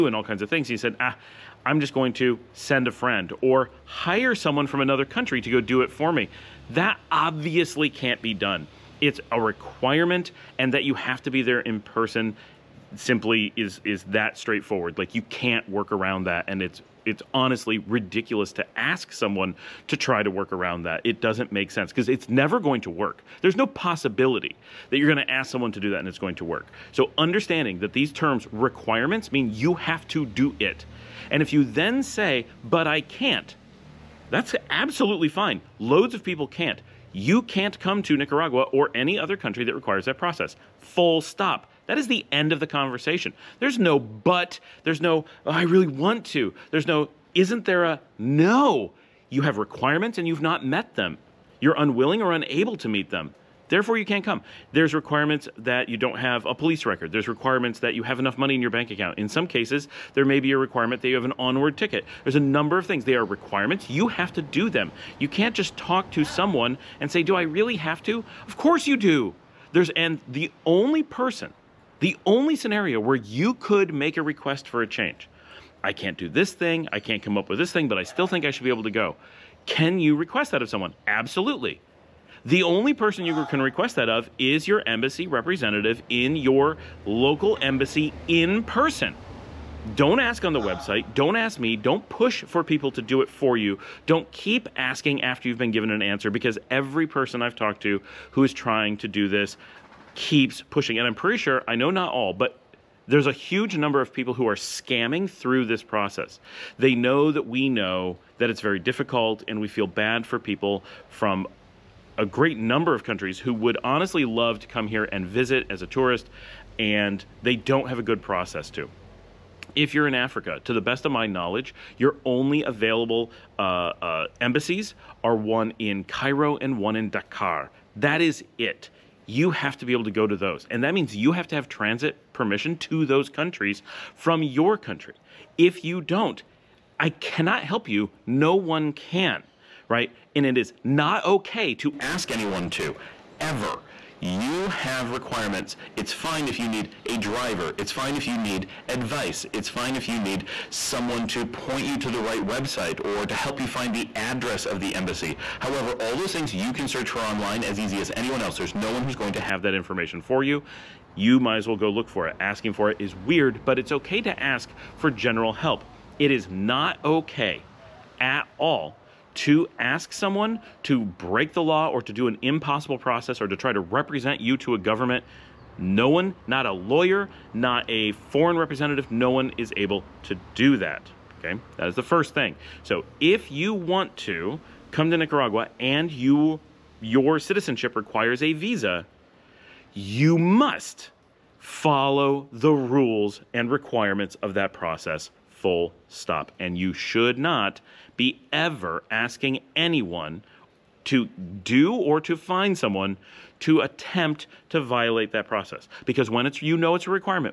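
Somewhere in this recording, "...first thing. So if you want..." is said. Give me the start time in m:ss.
3:02.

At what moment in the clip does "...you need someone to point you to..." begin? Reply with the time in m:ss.
2:30.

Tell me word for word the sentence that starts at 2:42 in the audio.
Asking for it is weird, but it's okay to ask for general help.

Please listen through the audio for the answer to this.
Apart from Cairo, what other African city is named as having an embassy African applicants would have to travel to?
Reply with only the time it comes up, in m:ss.
2:07.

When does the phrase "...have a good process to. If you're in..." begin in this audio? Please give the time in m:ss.
1:57.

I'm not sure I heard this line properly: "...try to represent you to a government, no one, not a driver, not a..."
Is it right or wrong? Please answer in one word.
wrong.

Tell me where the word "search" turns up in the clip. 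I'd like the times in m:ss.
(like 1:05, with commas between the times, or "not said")
2:36.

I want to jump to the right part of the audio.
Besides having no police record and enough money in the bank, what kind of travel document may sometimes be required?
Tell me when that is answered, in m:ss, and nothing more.
1:01.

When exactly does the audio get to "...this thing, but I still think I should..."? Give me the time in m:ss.
1:17.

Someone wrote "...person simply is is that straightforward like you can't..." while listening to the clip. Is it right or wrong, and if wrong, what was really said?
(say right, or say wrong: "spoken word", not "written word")
right.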